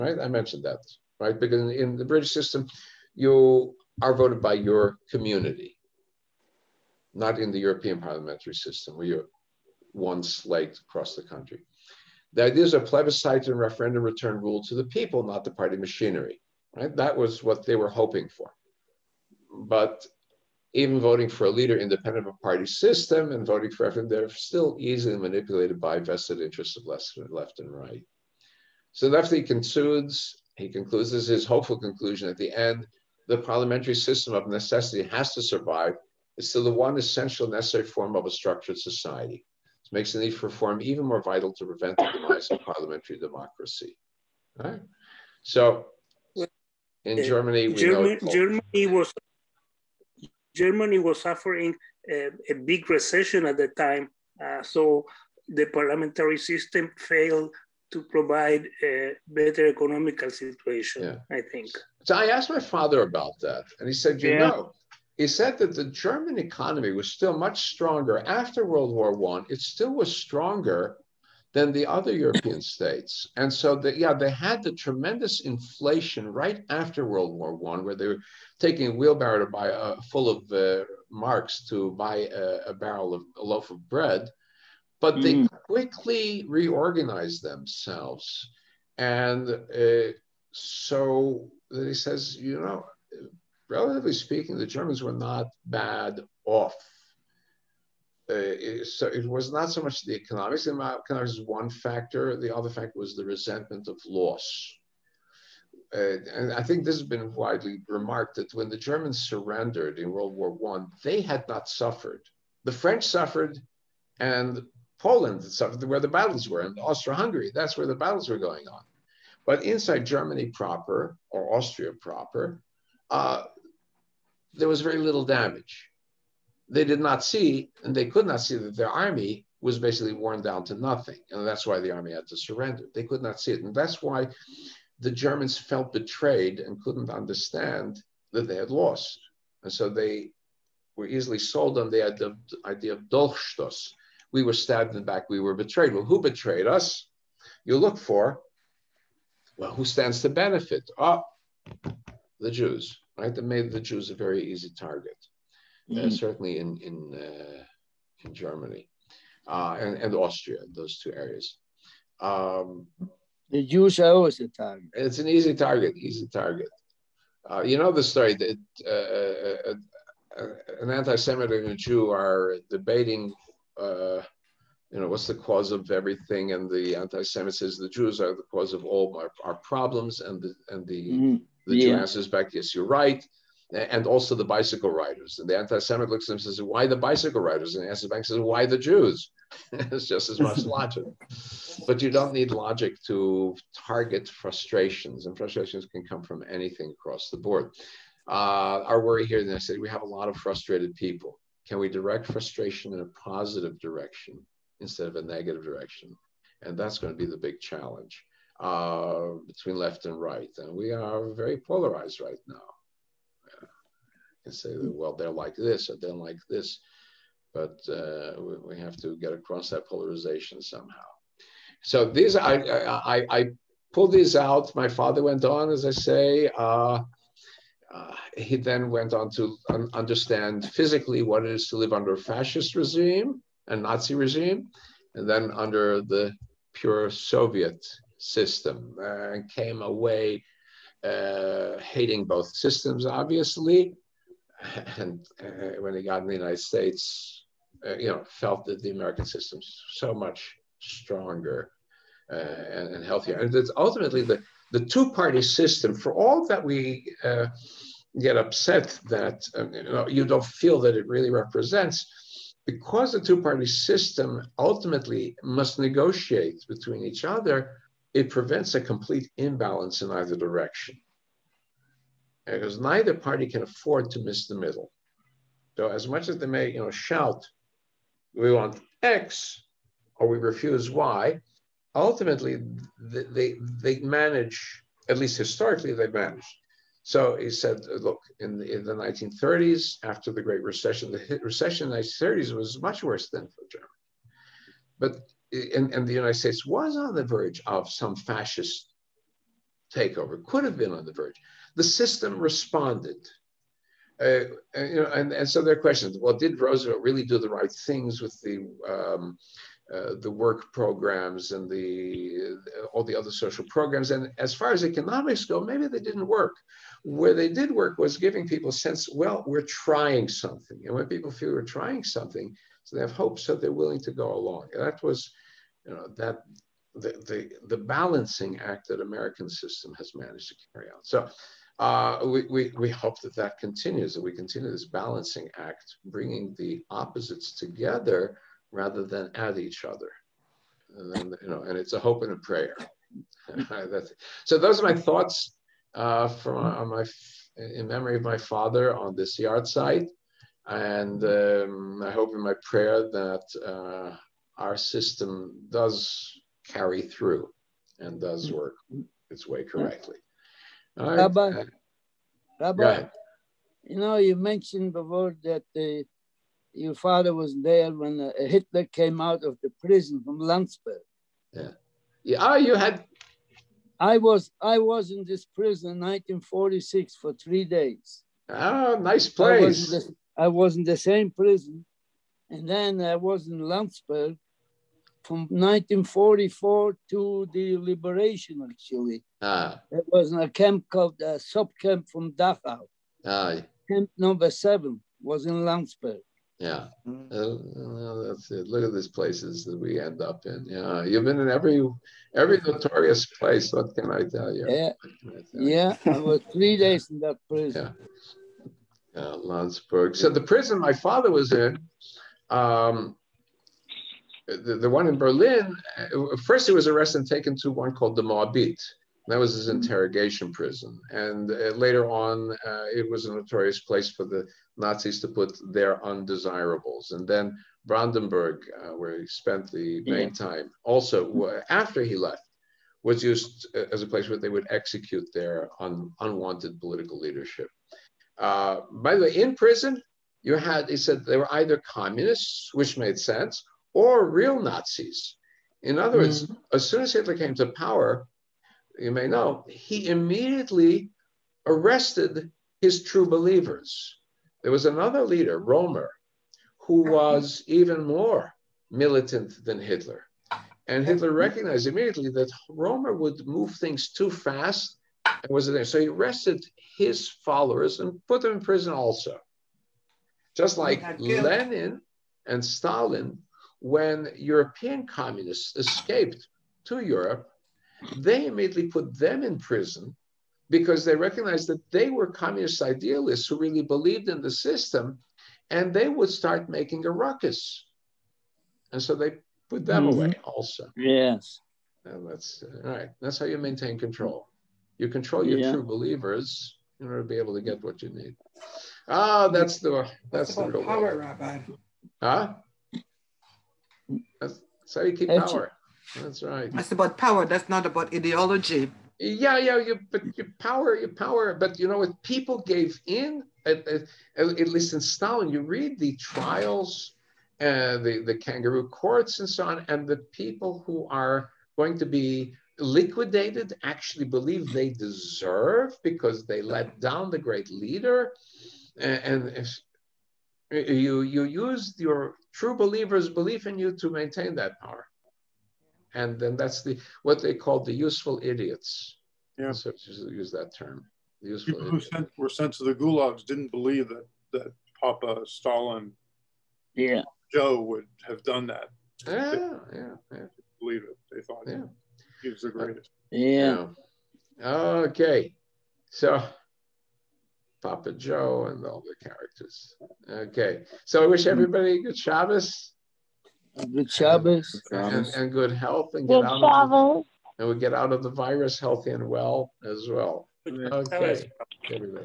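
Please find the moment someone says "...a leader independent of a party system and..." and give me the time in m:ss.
0:21.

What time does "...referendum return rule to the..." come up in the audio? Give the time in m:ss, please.
0:13.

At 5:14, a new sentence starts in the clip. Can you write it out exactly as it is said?
And as far as economics go, maybe they didn't work.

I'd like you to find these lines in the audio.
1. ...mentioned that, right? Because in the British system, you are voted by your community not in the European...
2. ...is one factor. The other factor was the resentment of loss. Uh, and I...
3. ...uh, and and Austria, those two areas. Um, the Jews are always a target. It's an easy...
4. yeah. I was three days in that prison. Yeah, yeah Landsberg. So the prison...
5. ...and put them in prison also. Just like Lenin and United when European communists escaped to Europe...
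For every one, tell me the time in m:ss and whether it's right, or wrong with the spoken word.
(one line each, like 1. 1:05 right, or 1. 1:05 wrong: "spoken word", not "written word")
1. 0:00 right
2. 1:41 right
3. 2:39 right
4. 6:45 right
5. 7:48 wrong: "Stalin", not "United".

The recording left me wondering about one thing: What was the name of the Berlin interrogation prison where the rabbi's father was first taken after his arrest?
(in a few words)
Moabit.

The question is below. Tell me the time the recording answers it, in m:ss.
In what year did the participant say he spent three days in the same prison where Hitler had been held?
6:16.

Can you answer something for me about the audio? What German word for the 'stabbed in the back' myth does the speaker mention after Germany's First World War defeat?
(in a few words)
Dolchstoss.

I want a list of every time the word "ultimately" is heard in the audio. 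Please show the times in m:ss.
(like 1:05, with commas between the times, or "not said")
4:13, 4:24, 4:41.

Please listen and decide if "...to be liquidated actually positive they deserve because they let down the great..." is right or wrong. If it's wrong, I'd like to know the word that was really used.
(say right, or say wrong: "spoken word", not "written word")
wrong: "believe", not "positive".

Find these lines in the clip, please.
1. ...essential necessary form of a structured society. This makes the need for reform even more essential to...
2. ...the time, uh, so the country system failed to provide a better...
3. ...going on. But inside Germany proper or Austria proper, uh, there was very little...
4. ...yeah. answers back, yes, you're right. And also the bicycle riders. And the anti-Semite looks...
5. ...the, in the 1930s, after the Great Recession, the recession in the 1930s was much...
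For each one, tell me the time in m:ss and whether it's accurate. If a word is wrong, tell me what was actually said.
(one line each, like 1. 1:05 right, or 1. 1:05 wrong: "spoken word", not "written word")
1. 0:36 wrong: "vital", not "essential"
2. 0:53 wrong: "parliamentary", not "country"
3. 1:58 right
4. 3:01 right
5. 4:48 right.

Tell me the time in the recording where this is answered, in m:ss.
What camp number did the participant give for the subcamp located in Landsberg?
6:34.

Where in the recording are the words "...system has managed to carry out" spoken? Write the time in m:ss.
5:29.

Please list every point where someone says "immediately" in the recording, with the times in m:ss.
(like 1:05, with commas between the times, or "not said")
7:30, 7:41, 7:58.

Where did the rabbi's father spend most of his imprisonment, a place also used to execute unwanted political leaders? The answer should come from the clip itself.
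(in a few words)
Brandenburg.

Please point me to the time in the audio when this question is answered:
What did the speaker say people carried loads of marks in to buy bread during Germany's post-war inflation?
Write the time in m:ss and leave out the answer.
1:18.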